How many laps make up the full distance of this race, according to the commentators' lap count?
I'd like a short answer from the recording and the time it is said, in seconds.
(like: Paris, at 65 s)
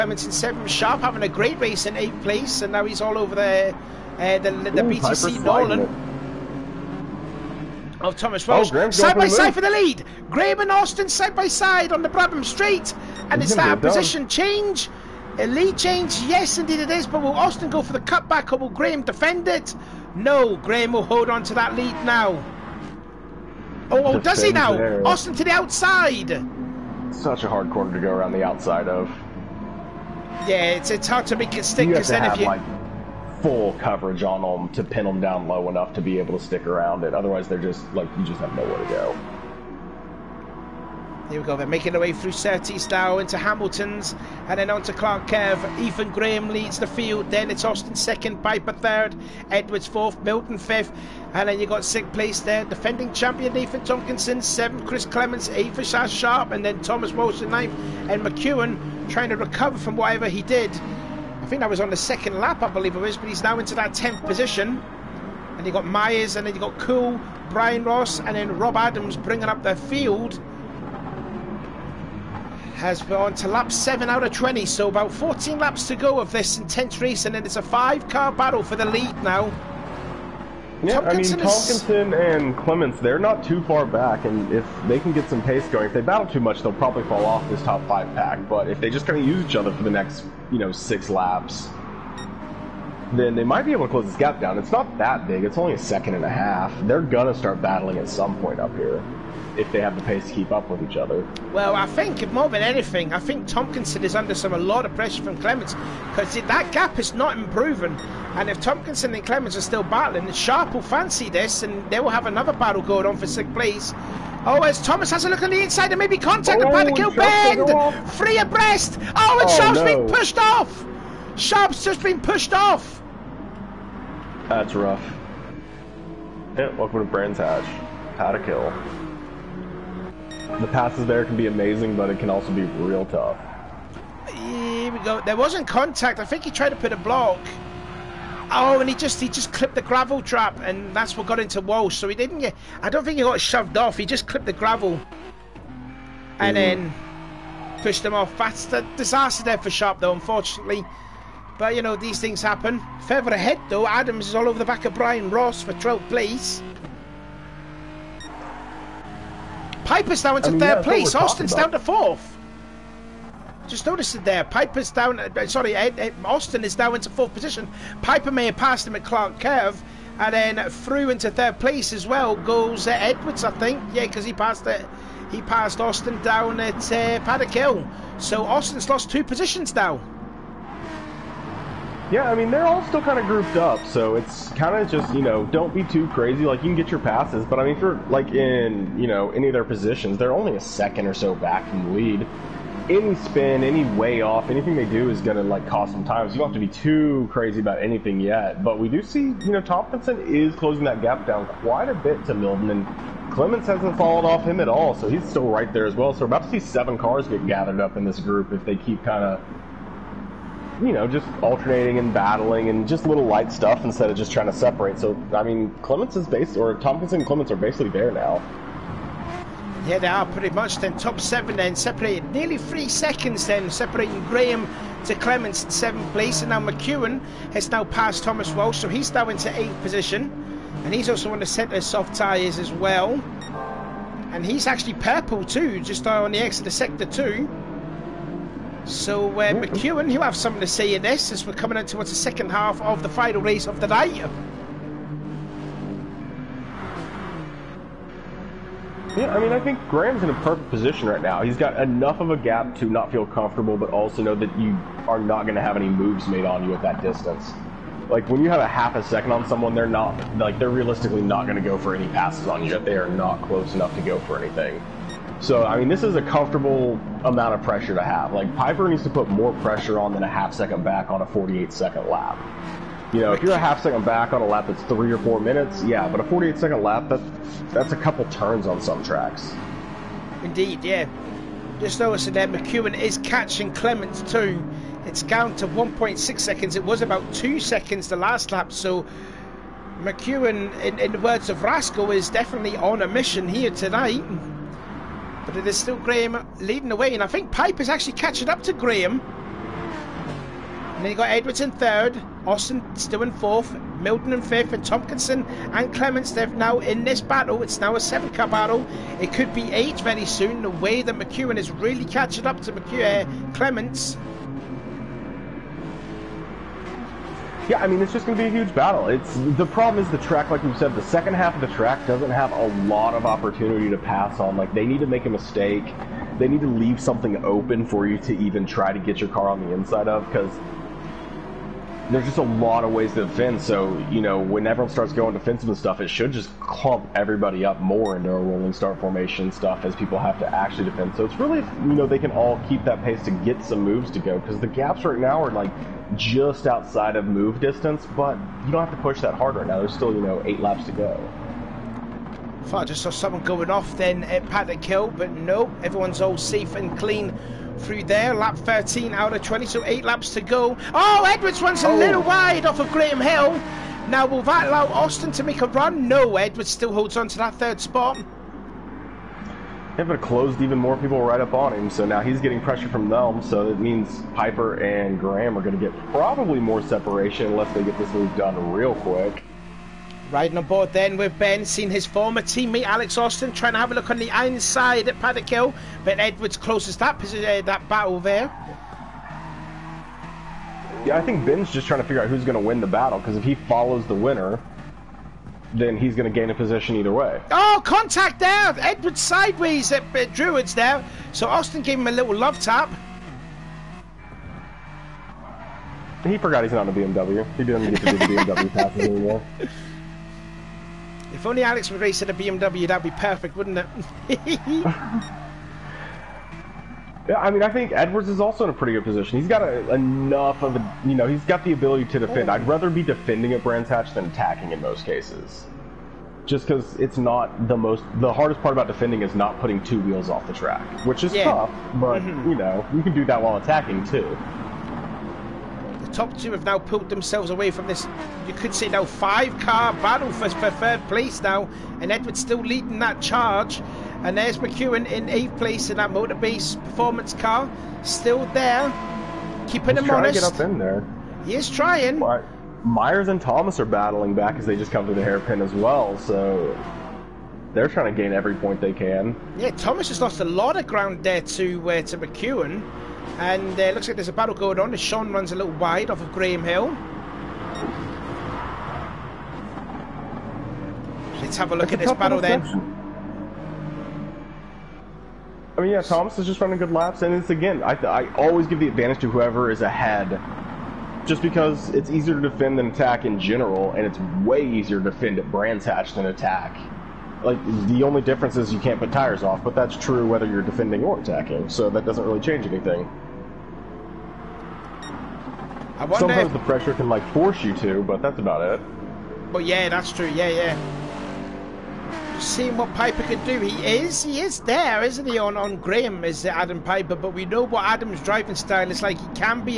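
20, at 73 s.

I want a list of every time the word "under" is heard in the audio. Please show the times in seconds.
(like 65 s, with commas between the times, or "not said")
104 s.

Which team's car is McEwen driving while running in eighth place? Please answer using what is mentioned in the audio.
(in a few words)
Motorbase Performance.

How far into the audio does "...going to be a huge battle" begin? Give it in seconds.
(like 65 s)
318 s.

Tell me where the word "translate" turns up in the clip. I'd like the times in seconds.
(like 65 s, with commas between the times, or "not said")
not said.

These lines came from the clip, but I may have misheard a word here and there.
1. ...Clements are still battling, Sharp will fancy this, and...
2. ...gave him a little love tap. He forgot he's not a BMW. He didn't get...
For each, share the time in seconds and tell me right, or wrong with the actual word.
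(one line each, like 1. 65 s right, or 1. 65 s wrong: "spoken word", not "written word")
1. 109 s right
2. 401 s right.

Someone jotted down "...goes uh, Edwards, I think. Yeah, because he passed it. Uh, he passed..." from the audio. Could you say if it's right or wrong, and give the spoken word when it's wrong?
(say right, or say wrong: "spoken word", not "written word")
right.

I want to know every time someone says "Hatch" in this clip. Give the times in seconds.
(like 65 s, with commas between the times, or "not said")
127 s, 423 s, 485 s.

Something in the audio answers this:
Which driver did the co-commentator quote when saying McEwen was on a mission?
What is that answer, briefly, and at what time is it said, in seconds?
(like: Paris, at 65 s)
Rascal, at 291 s.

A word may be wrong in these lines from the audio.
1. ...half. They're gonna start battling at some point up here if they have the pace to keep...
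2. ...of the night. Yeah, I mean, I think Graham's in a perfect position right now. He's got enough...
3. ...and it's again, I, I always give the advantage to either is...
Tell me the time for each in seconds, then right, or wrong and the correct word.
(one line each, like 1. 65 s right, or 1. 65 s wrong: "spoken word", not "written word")
1. 96 s right
2. 243 s right
3. 477 s wrong: "whoever", not "either".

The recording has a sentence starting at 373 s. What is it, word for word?
So it means Piper and Graham are going to get probably more separation unless they get this move done real quick.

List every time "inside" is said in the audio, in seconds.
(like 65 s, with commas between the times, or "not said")
115 s, 329 s, 384 s.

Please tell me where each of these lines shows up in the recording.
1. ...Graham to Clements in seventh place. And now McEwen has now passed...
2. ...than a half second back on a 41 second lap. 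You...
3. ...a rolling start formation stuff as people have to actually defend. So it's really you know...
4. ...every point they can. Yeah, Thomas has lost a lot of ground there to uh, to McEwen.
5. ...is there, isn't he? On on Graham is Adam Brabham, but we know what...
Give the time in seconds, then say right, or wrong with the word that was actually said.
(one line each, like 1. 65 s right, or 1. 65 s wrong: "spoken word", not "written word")
1. 224 s right
2. 270 s wrong: "48", not "41"
3. 338 s right
4. 458 s right
5. 504 s wrong: "Piper", not "Brabham".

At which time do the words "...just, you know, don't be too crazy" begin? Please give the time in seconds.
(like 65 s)
184 s.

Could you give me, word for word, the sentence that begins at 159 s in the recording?
Piper's now into I mean, third yeah, place.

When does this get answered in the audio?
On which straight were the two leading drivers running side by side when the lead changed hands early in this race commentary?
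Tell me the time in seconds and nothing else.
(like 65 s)
12 s.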